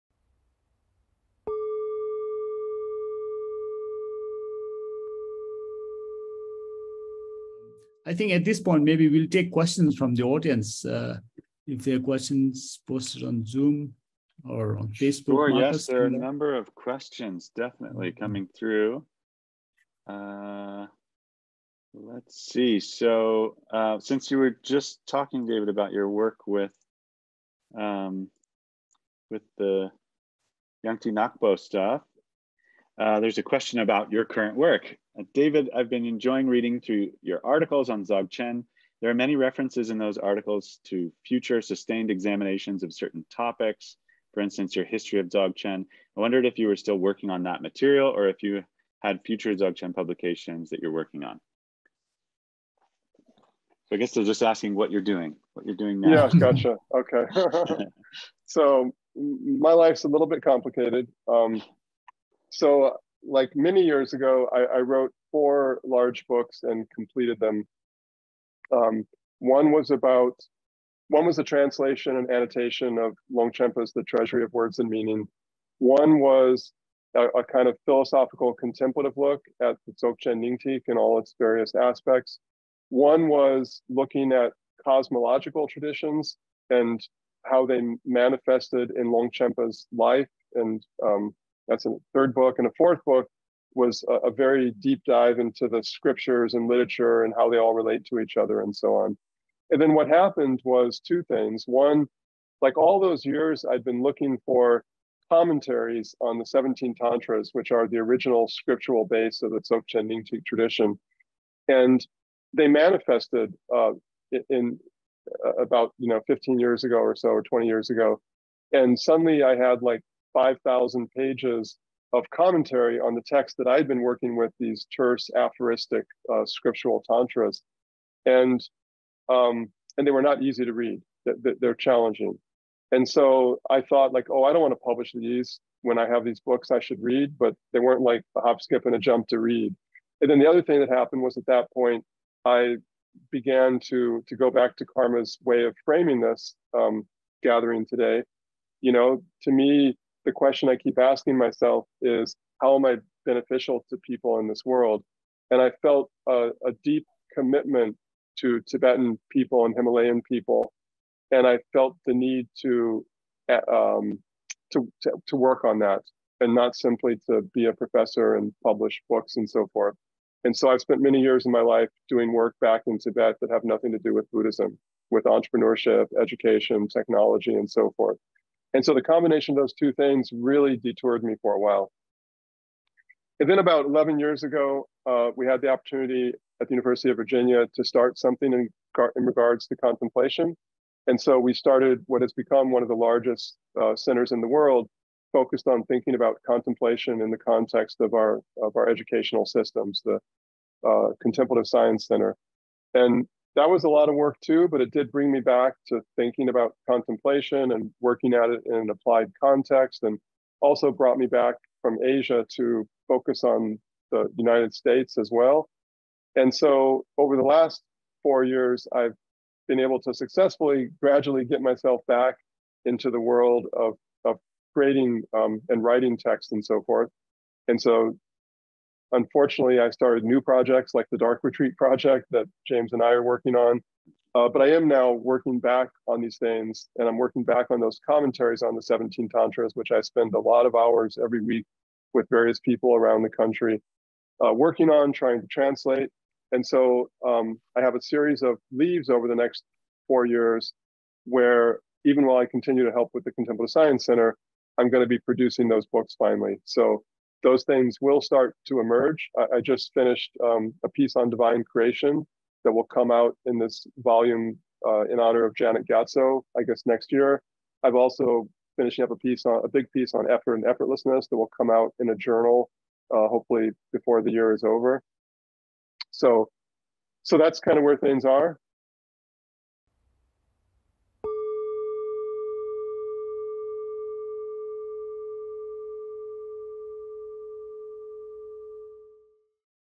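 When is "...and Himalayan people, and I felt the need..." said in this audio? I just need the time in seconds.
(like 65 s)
159 s.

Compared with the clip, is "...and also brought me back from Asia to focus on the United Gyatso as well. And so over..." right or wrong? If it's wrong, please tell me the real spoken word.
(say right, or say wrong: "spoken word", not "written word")
wrong: "States", not "Gyatso".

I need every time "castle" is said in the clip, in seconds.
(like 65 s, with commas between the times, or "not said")
not said.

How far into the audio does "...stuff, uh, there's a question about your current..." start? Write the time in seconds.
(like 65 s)
31 s.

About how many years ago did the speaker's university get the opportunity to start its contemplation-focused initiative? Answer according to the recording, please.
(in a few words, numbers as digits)
11.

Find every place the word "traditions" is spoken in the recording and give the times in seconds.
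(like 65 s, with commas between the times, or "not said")
85 s, 110 s.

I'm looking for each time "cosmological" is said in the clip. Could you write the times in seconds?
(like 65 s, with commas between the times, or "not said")
84 s.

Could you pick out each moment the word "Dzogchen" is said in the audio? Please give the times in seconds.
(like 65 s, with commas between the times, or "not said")
38 s, 45 s, 49 s, 79 s, 109 s.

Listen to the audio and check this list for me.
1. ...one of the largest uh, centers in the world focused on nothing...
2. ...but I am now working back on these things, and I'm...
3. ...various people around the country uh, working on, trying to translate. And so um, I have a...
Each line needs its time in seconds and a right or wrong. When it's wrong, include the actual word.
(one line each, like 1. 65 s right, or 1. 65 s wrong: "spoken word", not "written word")
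1. 192 s wrong: "thinking", not "nothing"
2. 234 s right
3. 242 s right.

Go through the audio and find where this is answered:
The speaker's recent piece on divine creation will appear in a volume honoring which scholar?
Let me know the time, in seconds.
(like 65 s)
265 s.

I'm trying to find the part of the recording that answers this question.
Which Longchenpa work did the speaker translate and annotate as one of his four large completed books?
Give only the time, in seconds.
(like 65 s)
73 s.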